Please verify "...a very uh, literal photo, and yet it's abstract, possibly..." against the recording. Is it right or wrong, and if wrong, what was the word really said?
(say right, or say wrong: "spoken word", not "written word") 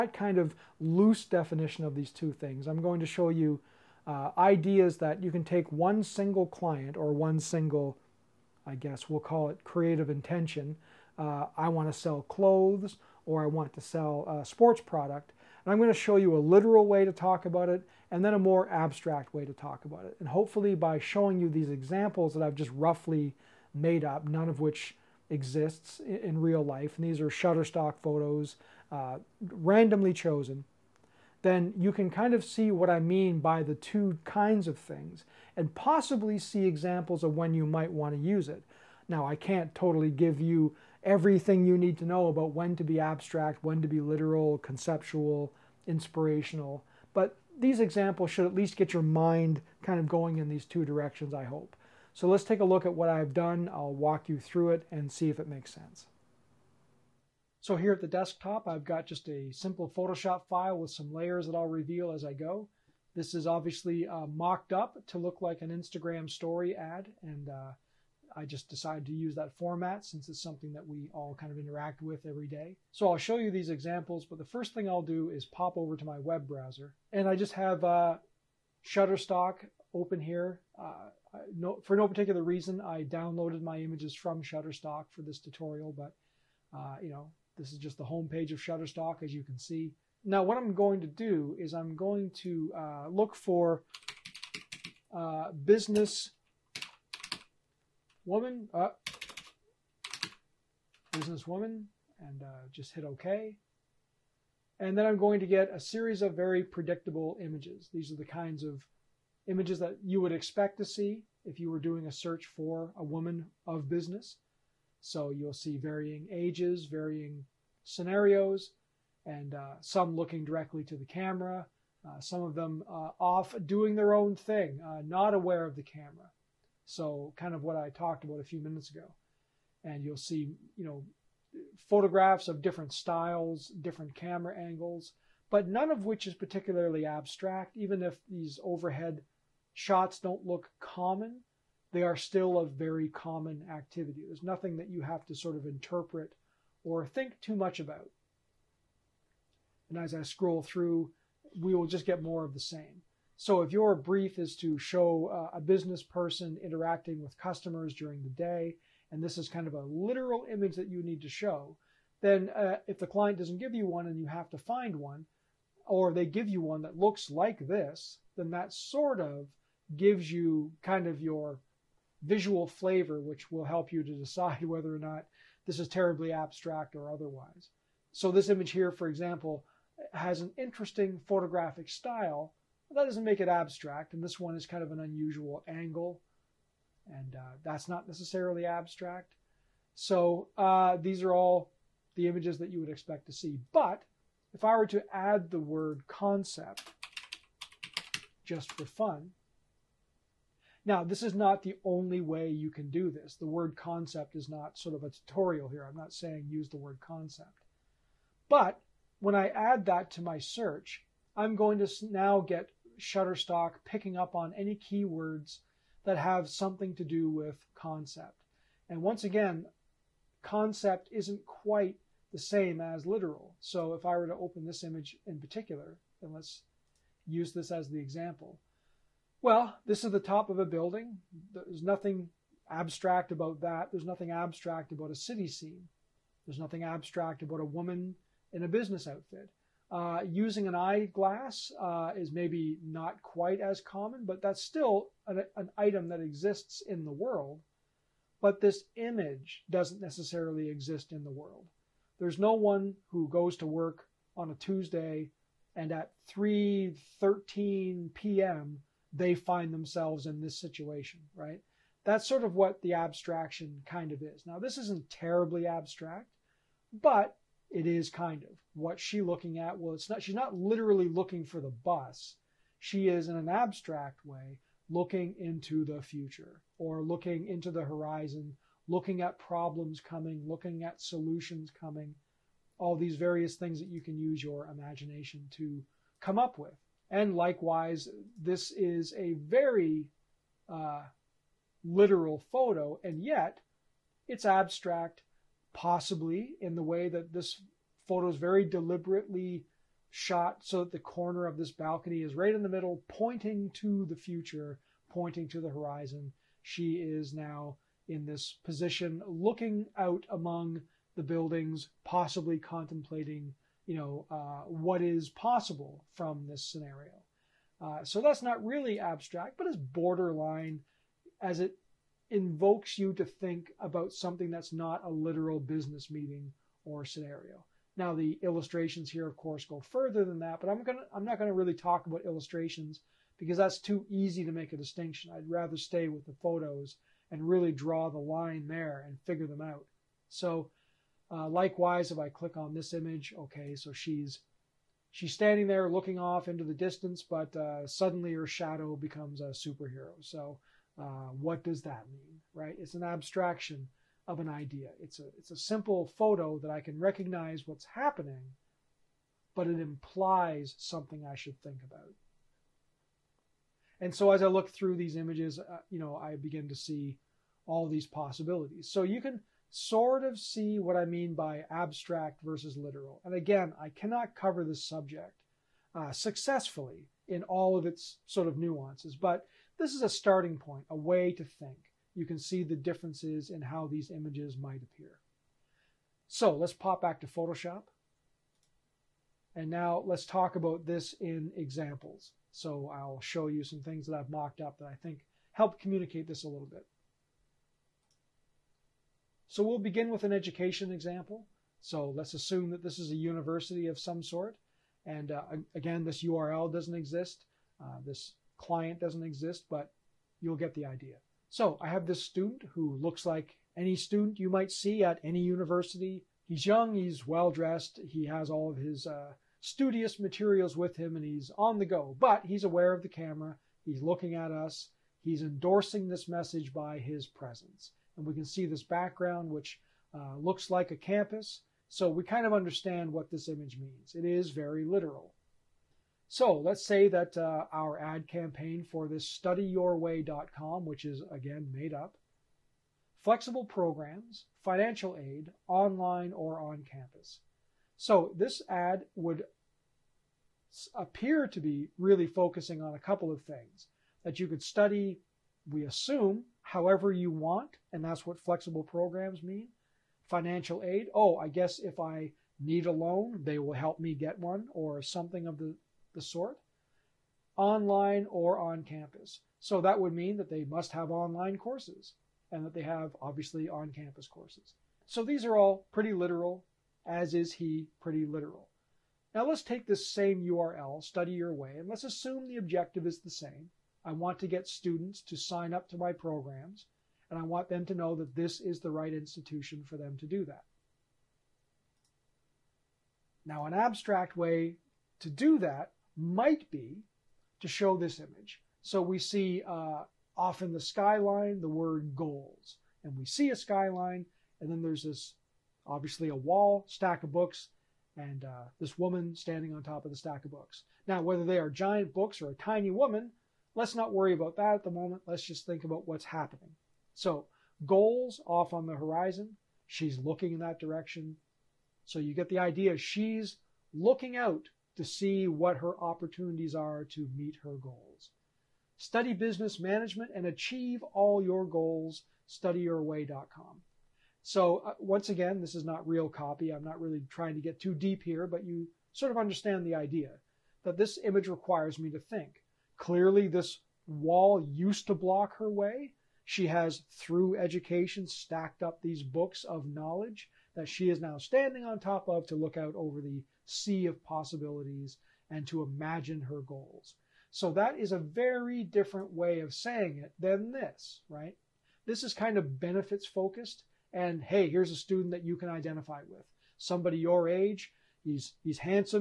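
right.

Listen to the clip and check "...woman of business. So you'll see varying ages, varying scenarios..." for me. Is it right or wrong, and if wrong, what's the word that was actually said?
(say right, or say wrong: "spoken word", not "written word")
right.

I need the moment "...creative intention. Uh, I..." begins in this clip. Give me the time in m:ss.
0:09.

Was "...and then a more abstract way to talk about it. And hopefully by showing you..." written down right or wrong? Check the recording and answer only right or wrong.
right.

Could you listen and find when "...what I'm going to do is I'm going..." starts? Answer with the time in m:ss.
1:30.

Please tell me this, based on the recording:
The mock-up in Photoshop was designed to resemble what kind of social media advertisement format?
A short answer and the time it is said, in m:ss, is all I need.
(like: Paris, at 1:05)
Instagram story ad, at 1:05.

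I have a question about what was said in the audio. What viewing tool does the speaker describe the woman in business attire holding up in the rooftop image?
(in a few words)
eyeglass.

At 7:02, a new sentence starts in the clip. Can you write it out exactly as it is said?
But he's aware of the camera, he's looking at us, he's endorsing this message by his presence.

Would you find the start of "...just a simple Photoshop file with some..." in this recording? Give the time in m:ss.
0:59.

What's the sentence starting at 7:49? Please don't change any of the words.
So that would mean that they must have online courses and that they have obviously on campus courses.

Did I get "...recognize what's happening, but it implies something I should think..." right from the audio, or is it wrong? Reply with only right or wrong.
right.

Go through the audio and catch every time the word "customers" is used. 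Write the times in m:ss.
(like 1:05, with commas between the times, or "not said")
2:37.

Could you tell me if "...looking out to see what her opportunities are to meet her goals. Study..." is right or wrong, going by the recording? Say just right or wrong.
right.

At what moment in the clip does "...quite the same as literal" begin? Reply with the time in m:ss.
3:41.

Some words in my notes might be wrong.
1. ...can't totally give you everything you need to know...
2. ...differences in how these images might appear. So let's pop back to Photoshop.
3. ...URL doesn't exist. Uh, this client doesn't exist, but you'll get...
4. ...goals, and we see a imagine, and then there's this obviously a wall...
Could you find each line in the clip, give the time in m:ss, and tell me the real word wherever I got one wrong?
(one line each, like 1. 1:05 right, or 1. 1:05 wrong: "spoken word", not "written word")
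1. 0:39 right
2. 6:22 right
3. 6:46 right
4. 8:22 wrong: "skyline", not "imagine".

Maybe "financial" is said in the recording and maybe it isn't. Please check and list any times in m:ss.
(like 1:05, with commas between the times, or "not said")
7:24, 7:40.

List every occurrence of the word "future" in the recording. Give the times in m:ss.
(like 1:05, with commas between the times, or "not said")
4:35, 5:04.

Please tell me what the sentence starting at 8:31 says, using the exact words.
Now, whether they are giant books or a tiny woman, let's not worry about that at the moment.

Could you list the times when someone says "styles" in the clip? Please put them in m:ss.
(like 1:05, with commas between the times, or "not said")
2:12, 3:01.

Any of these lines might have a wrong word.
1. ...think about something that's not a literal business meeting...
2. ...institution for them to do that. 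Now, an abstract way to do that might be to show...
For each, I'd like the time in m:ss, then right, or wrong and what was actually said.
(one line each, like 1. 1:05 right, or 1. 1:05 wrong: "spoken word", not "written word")
1. 5:23 right
2. 8:09 right.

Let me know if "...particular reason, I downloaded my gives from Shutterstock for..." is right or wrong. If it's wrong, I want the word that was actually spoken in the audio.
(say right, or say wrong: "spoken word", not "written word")
wrong: "images", not "gives".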